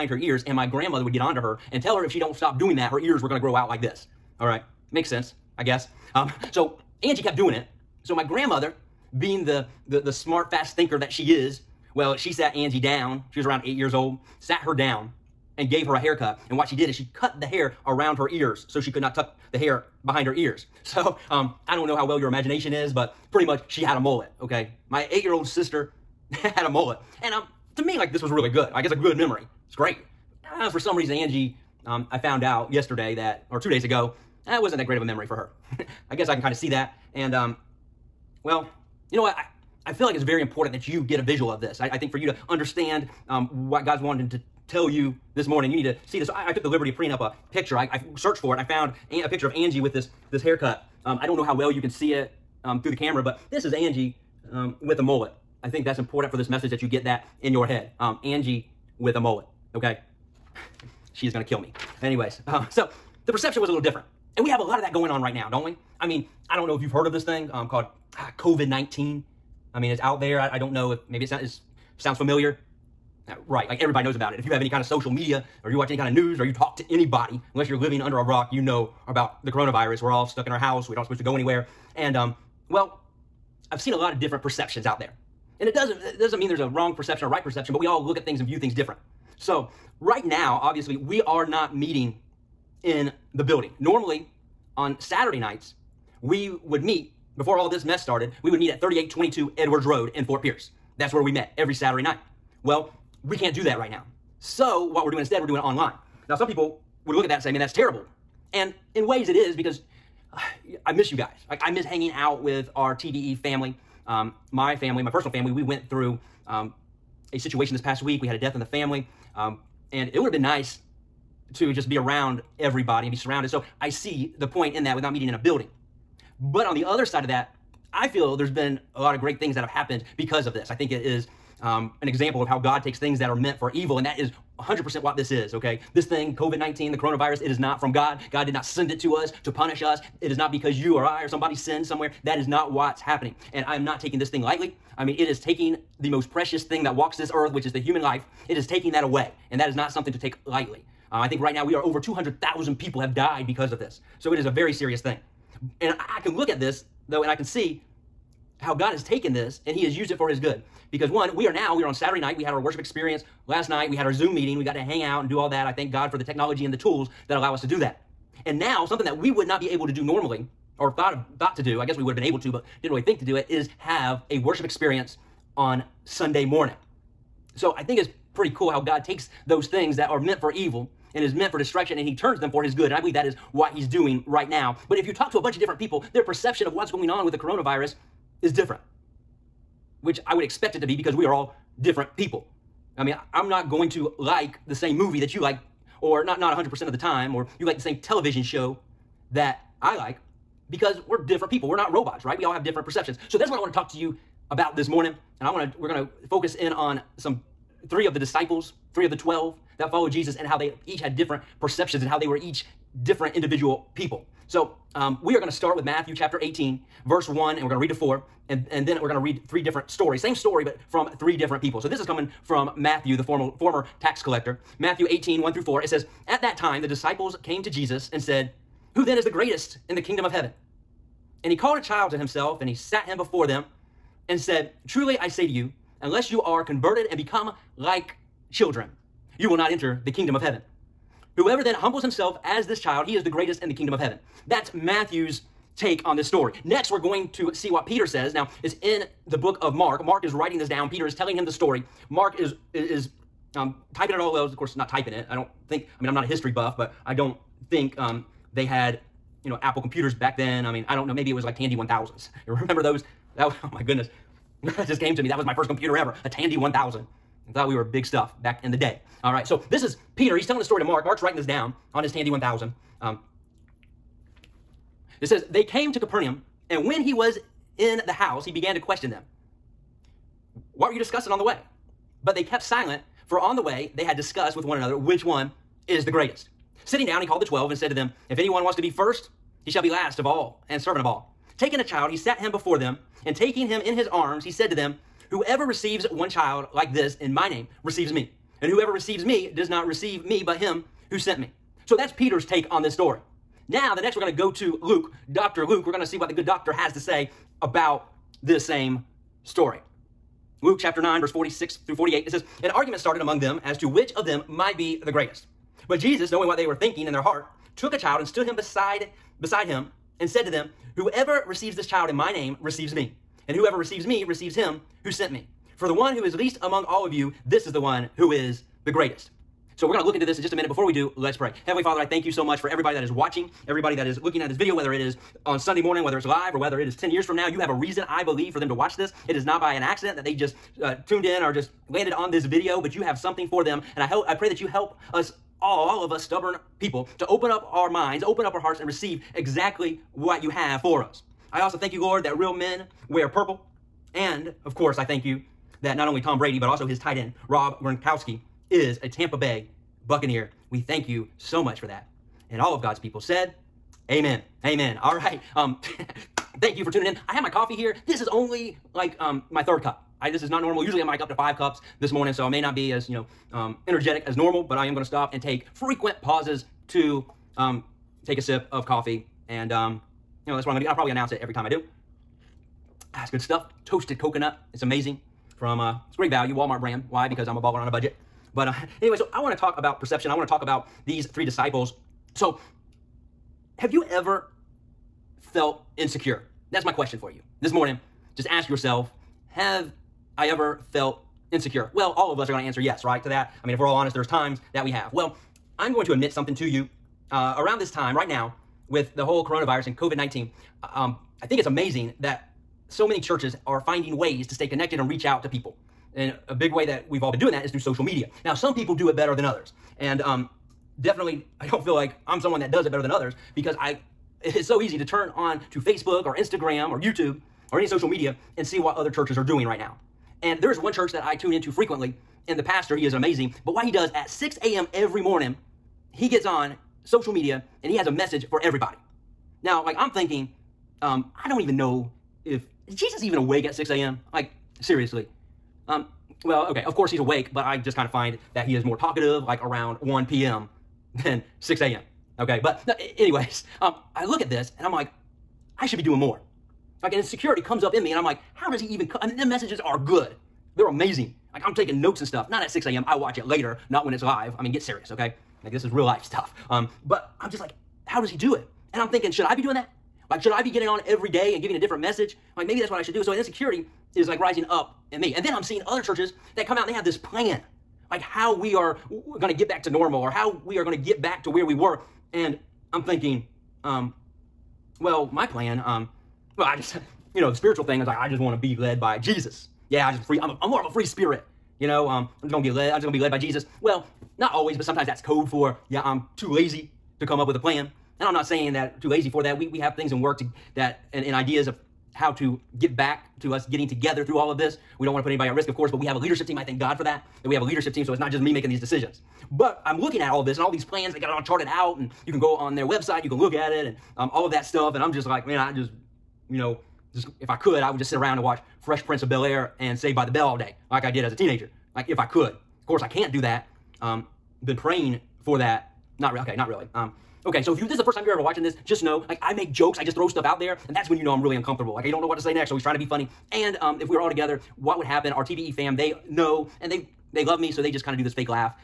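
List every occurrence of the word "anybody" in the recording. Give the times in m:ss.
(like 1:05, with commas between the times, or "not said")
1:16, 8:25.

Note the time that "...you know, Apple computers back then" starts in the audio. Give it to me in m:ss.
4:19.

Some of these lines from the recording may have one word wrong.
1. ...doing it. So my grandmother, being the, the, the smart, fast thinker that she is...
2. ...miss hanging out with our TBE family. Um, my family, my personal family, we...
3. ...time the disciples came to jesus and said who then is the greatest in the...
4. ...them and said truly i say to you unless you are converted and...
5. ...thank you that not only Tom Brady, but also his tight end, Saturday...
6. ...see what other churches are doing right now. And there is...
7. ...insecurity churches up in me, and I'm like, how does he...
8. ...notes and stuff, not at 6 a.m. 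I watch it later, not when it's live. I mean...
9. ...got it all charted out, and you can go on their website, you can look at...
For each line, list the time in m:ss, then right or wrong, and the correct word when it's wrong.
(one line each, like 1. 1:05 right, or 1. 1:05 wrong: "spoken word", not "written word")
1. 0:07 right
2. 1:51 right
3. 3:46 right
4. 3:53 right
5. 5:55 wrong: "Rob", not "Saturday"
6. 7:08 right
7. 7:37 wrong: "comes", not "churches"
8. 7:42 right
9. 8:31 right.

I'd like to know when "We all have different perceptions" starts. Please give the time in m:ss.
3:22.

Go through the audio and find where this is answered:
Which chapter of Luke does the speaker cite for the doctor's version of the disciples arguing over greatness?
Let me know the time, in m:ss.
5:10.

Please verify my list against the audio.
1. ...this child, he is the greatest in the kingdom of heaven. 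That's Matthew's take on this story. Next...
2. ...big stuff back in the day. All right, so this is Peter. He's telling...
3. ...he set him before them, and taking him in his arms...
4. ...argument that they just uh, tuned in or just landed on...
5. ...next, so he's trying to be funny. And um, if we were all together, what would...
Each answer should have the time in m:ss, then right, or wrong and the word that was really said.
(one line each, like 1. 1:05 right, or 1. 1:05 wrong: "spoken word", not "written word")
1. 4:02 right
2. 4:27 right
3. 4:52 right
4. 5:39 wrong: "accident", not "argument"
5. 8:52 right.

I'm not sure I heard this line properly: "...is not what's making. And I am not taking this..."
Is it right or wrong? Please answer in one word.
wrong.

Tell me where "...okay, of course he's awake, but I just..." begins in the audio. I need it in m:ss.
7:26.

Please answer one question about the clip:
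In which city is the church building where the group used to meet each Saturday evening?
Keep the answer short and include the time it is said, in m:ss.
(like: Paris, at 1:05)
Fort Pierce, at 1:40.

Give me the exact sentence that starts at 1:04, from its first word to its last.
And we have a lot of that going on right now, don't we?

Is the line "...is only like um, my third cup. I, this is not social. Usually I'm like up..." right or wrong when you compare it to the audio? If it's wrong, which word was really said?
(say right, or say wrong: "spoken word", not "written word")
wrong: "normal", not "social".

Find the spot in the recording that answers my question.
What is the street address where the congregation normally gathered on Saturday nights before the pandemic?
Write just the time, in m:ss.
1:38.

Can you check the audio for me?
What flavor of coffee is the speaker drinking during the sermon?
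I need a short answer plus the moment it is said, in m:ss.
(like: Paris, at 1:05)
Toasted coconut, at 6:23.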